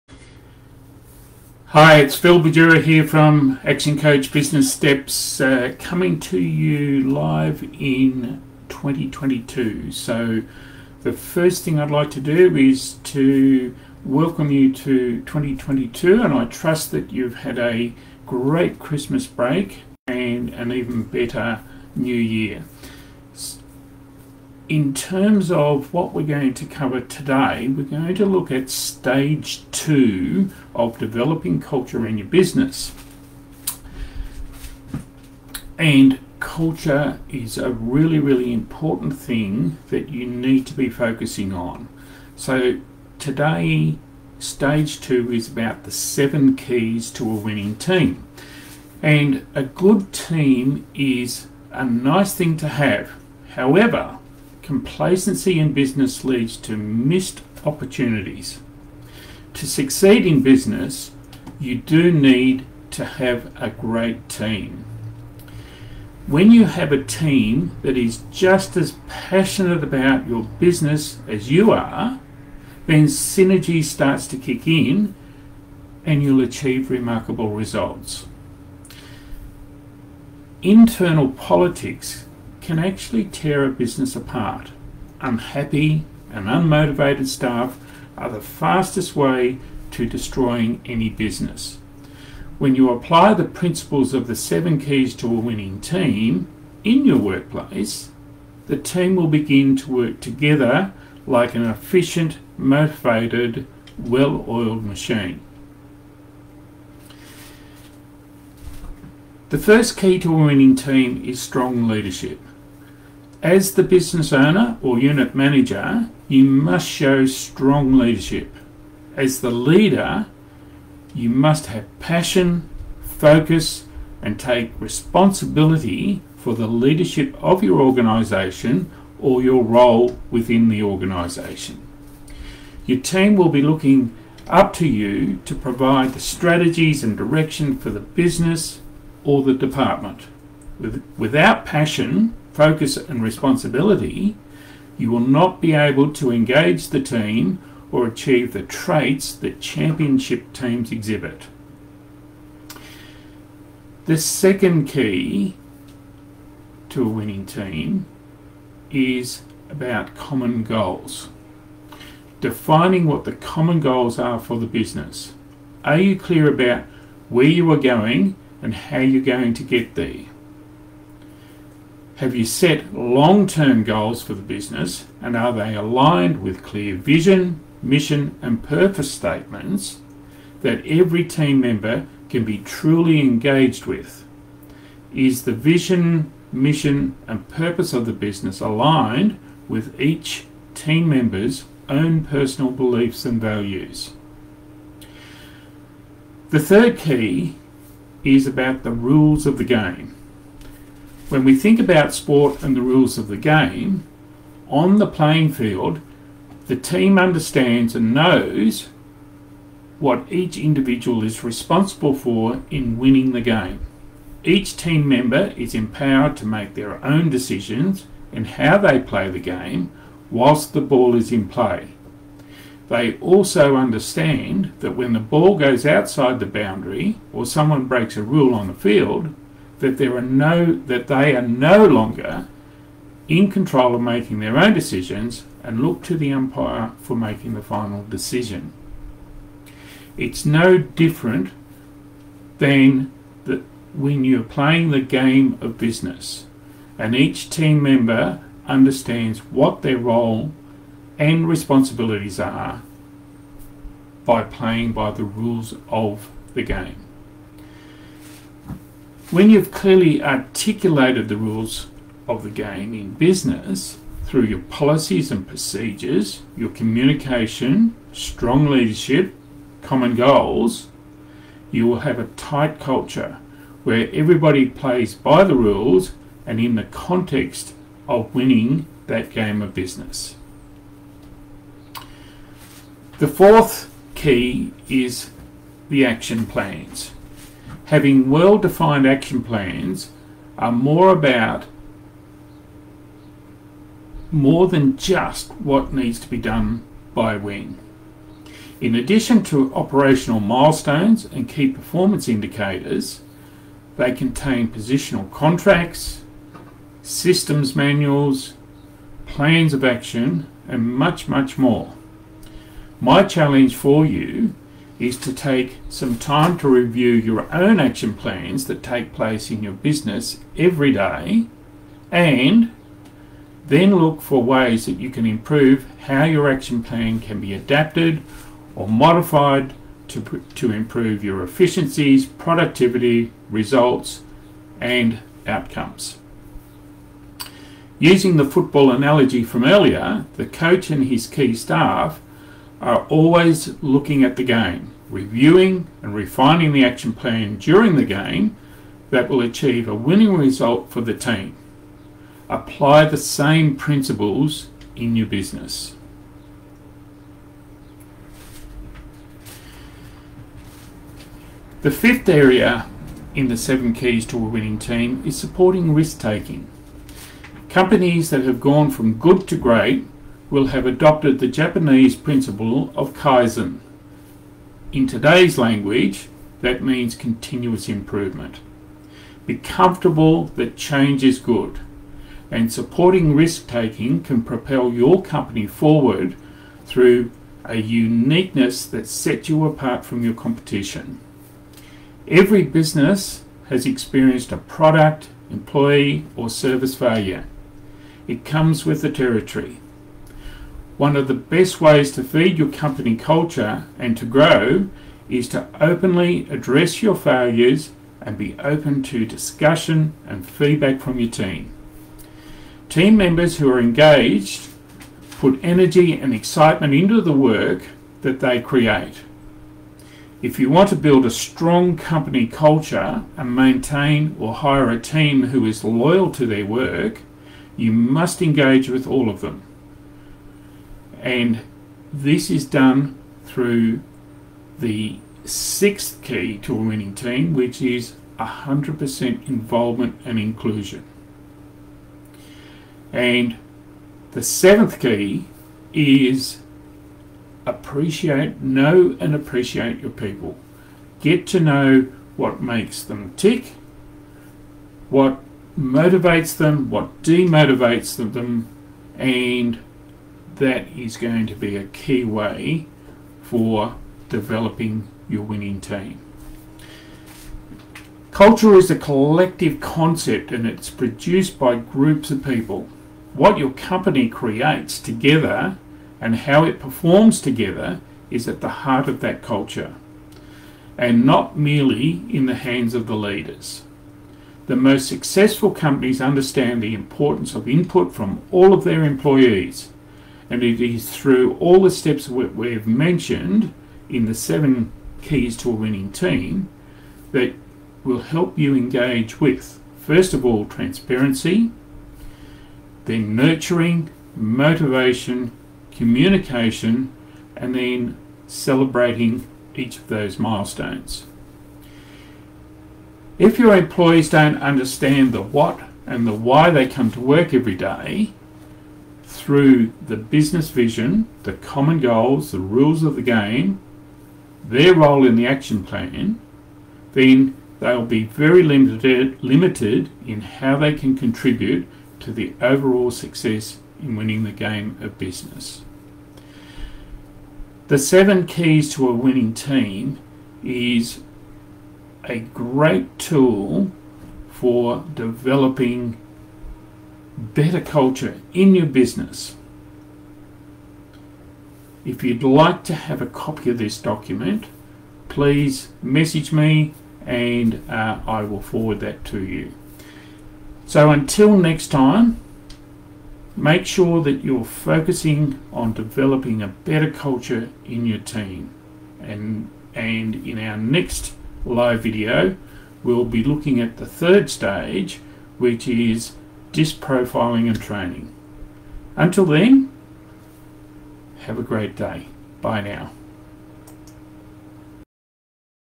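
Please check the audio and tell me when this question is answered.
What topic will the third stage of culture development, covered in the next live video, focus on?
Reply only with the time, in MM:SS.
09:36.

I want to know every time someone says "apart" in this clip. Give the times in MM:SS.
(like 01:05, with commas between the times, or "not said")
01:24, 06:29.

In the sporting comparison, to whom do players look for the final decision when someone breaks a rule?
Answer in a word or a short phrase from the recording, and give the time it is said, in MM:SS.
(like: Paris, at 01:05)
The umpire, at 03:56.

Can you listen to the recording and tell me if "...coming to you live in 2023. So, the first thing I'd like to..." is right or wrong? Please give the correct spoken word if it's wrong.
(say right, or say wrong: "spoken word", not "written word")
wrong: "2022", not "2023".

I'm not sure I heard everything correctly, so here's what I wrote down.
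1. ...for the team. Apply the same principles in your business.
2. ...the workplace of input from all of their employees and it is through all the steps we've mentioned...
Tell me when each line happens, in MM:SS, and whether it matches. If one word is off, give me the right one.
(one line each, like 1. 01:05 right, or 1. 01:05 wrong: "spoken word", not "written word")
1. 05:50 right
2. 08:06 wrong: "importance", not "workplace".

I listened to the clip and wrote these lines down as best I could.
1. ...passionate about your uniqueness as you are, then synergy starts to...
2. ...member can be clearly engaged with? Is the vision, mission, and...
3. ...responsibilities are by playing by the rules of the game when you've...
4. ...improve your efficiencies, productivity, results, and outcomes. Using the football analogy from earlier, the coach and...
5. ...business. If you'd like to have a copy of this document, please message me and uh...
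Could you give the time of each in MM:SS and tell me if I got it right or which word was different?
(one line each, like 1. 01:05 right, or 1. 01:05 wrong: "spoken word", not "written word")
1. 01:09 wrong: "business", not "uniqueness"
2. 03:01 wrong: "truly", not "clearly"
3. 04:11 right
4. 05:30 right
5. 09:08 right.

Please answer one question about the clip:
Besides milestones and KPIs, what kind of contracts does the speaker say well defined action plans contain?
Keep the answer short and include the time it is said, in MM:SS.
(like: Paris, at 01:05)
Positional contracts, at 05:04.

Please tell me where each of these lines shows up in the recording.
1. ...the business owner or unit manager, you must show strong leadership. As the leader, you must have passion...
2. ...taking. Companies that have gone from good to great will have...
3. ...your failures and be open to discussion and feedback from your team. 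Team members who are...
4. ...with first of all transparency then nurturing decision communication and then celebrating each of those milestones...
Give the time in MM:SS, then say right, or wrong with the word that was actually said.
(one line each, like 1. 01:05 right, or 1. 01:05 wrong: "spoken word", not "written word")
1. 01:53 right
2. 06:06 right
3. 06:47 right
4. 08:19 wrong: "motivation", not "decision".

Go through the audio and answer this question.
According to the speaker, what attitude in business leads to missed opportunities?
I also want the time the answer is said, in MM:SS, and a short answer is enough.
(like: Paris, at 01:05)
Complacency, at 00:54.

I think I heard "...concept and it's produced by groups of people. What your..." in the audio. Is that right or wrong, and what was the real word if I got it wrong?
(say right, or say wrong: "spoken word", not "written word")
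right.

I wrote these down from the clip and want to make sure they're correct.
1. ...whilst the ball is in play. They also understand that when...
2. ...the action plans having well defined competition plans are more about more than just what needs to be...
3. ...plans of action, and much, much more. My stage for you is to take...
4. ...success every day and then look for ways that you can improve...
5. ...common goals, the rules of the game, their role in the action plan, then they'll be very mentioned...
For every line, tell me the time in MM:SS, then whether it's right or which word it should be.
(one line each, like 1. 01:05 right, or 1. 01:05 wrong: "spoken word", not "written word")
1. 03:40 right
2. 04:45 wrong: "action", not "competition"
3. 05:09 wrong: "challenge", not "stage"
4. 05:19 wrong: "business", not "success"
5. 08:41 wrong: "limited", not "mentioned".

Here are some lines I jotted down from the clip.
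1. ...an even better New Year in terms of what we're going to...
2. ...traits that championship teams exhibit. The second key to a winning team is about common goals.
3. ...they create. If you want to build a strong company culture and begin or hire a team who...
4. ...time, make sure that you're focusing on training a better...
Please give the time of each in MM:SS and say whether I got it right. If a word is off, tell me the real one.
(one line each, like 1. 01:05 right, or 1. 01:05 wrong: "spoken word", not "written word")
1. 00:20 right
2. 02:28 right
3. 06:58 wrong: "maintain", not "begin"
4. 09:21 wrong: "developing", not "training".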